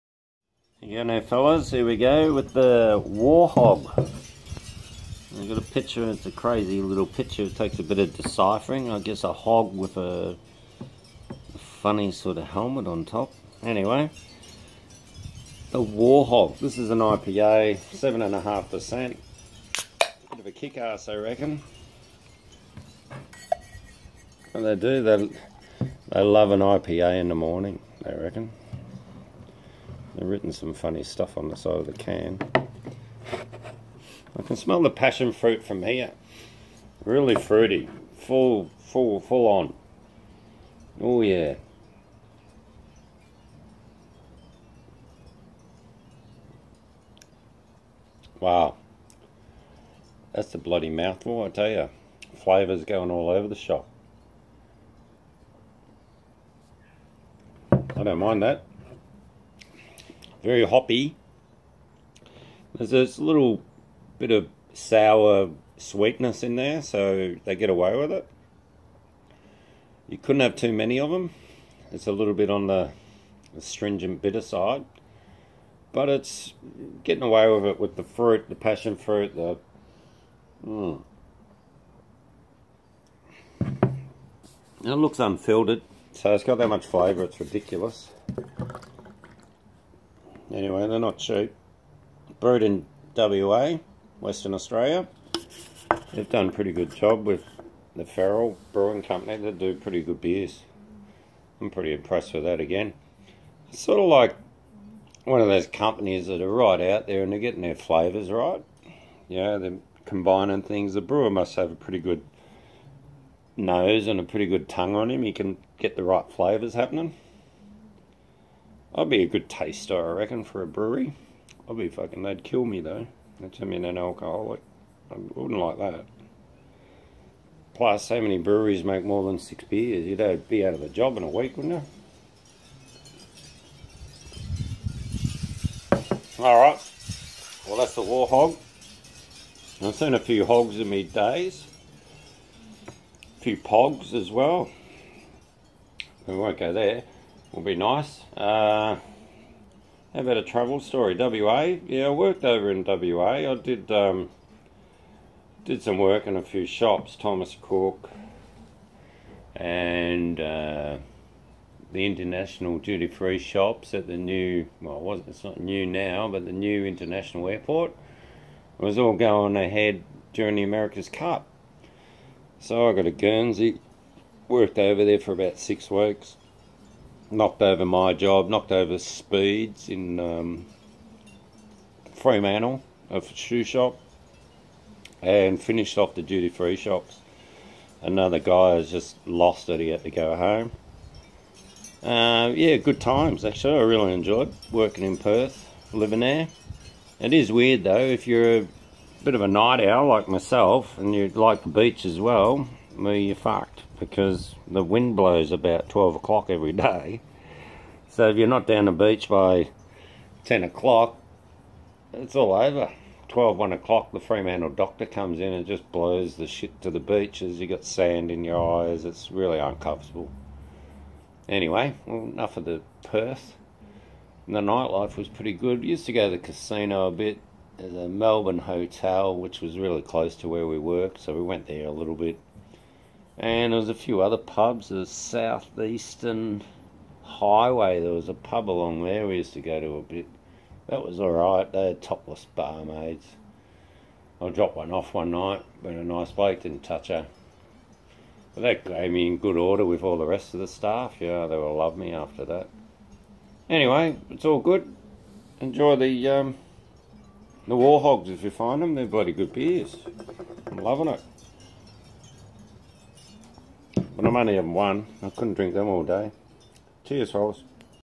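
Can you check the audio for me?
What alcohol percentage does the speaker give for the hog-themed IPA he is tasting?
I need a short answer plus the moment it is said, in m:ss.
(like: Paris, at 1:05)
7.5%, at 0:17.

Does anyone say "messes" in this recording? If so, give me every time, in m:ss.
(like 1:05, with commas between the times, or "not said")
not said.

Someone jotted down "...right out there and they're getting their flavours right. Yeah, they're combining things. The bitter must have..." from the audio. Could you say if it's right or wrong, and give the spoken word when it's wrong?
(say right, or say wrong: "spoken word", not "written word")
wrong: "brewer", not "bitter".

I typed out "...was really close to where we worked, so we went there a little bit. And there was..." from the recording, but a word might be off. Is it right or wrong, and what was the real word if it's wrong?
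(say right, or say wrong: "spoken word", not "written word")
right.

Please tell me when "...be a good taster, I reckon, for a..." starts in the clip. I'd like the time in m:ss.
1:59.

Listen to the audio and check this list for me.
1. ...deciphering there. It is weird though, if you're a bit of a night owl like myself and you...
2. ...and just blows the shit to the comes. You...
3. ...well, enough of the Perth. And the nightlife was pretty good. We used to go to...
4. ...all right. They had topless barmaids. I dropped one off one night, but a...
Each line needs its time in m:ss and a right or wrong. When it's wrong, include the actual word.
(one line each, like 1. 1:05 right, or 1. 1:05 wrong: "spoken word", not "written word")
1. 3:15 wrong: "living", not "deciphering"
2. 3:35 wrong: "beaches", not "comes"
3. 3:42 right
4. 4:01 right.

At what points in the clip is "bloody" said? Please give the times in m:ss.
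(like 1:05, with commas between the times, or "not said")
0:50, 4:19.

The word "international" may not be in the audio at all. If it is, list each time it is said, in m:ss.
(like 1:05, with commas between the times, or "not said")
2:42, 2:46.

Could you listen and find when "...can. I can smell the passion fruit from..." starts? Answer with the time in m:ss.
0:31.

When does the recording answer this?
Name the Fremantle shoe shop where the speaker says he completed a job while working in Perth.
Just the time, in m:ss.
2:58.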